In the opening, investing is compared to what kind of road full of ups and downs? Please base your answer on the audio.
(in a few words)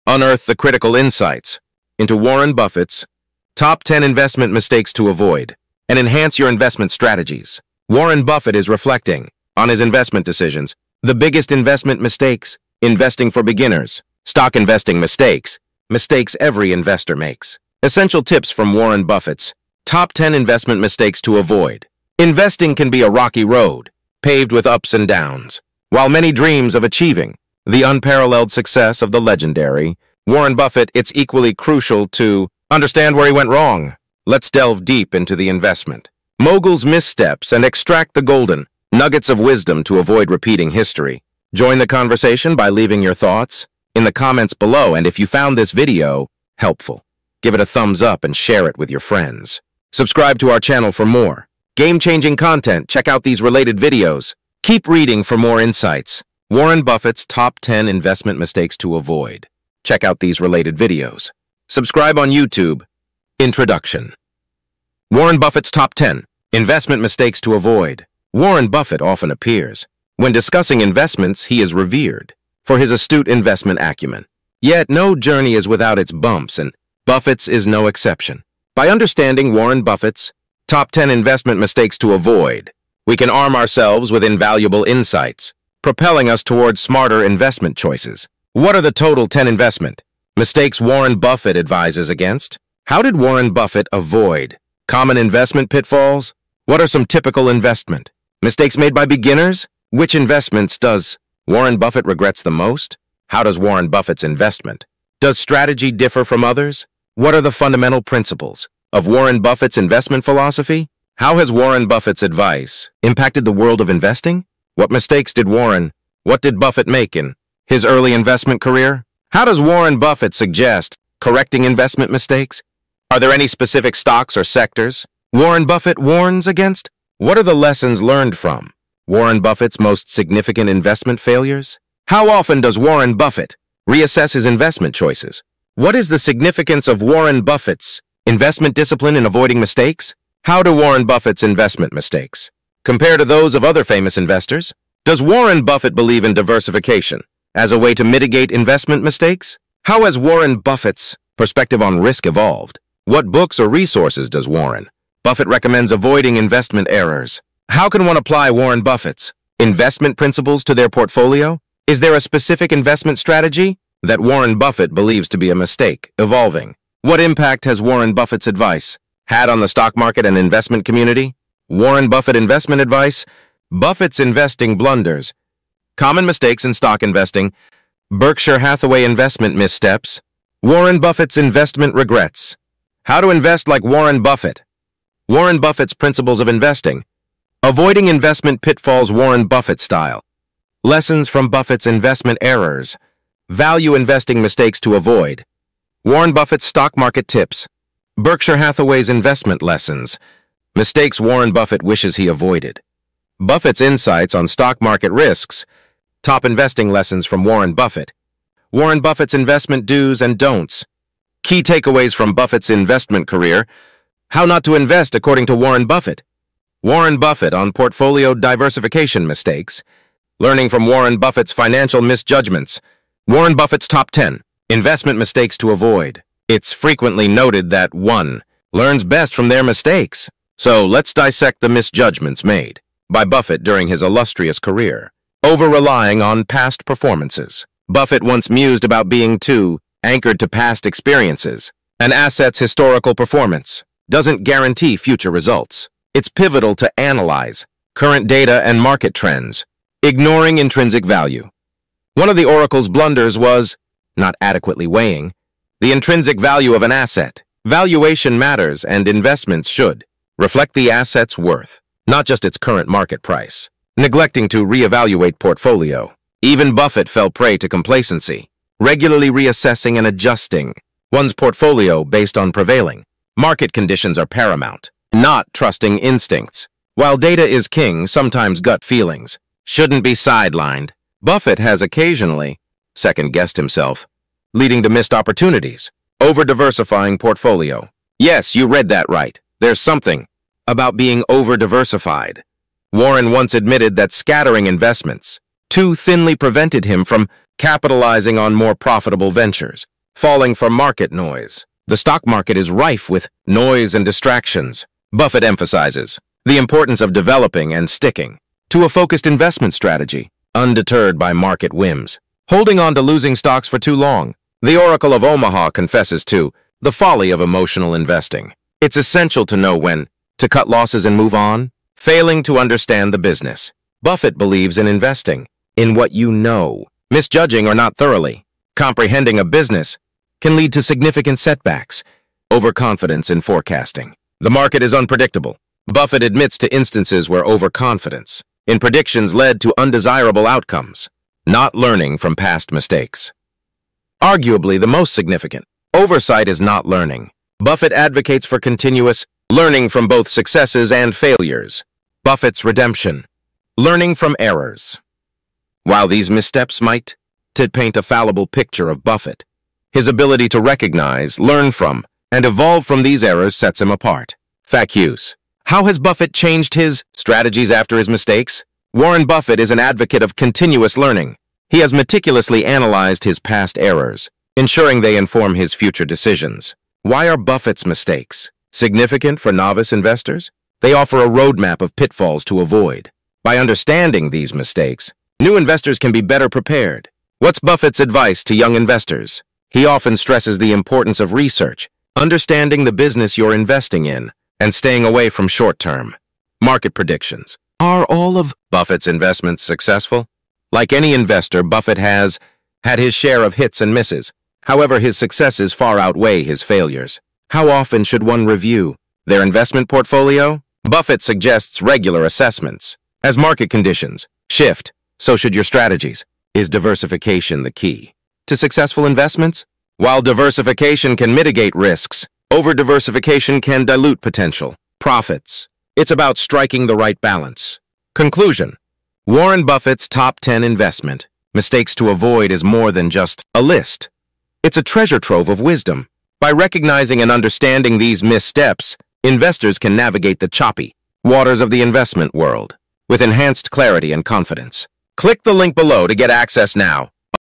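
rocky road.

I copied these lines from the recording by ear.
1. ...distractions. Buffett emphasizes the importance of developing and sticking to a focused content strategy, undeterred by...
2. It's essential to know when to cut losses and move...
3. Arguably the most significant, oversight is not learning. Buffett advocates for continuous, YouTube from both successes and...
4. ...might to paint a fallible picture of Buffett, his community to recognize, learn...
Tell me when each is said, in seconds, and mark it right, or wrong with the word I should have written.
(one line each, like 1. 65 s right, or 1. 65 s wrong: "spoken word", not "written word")
1. 304 s wrong: "investment", not "content"
2. 318 s right
3. 344 s wrong: "Learning", not "YouTube"
4. 356 s wrong: "ability", not "community".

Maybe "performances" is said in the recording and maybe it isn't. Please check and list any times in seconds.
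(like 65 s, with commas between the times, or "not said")
236 s, 243 s.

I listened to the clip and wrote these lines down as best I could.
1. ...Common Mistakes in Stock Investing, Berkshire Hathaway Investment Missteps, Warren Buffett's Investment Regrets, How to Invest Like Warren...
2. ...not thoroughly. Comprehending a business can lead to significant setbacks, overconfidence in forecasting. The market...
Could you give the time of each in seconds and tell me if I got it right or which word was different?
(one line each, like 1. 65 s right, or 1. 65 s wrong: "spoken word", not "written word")
1. 175 s right
2. 327 s right.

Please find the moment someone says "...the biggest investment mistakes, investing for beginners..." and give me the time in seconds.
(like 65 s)
11 s.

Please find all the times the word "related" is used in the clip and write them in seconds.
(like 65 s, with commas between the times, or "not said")
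53 s, 60 s.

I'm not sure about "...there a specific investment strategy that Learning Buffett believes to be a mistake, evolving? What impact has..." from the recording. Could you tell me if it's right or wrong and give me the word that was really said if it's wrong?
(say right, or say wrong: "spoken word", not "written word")
wrong: "Warren", not "Learning".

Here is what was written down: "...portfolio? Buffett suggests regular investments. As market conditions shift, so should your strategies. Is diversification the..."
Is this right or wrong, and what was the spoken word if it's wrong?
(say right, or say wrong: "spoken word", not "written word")
wrong: "assessments", not "investments".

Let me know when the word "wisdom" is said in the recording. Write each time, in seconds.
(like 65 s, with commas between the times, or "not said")
39 s, 435 s.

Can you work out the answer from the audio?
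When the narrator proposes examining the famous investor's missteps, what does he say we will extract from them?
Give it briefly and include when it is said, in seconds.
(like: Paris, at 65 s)
golden nuggets, at 38 s.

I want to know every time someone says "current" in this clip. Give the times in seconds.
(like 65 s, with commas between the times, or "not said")
247 s, 262 s.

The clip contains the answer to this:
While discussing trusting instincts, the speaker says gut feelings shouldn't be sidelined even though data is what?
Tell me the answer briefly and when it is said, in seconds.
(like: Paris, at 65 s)
king, at 277 s.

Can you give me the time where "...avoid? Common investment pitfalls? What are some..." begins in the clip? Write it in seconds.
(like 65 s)
93 s.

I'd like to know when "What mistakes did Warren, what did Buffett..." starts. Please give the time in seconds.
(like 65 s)
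114 s.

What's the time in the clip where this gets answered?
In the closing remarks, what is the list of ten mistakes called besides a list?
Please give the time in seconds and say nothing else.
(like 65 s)
434 s.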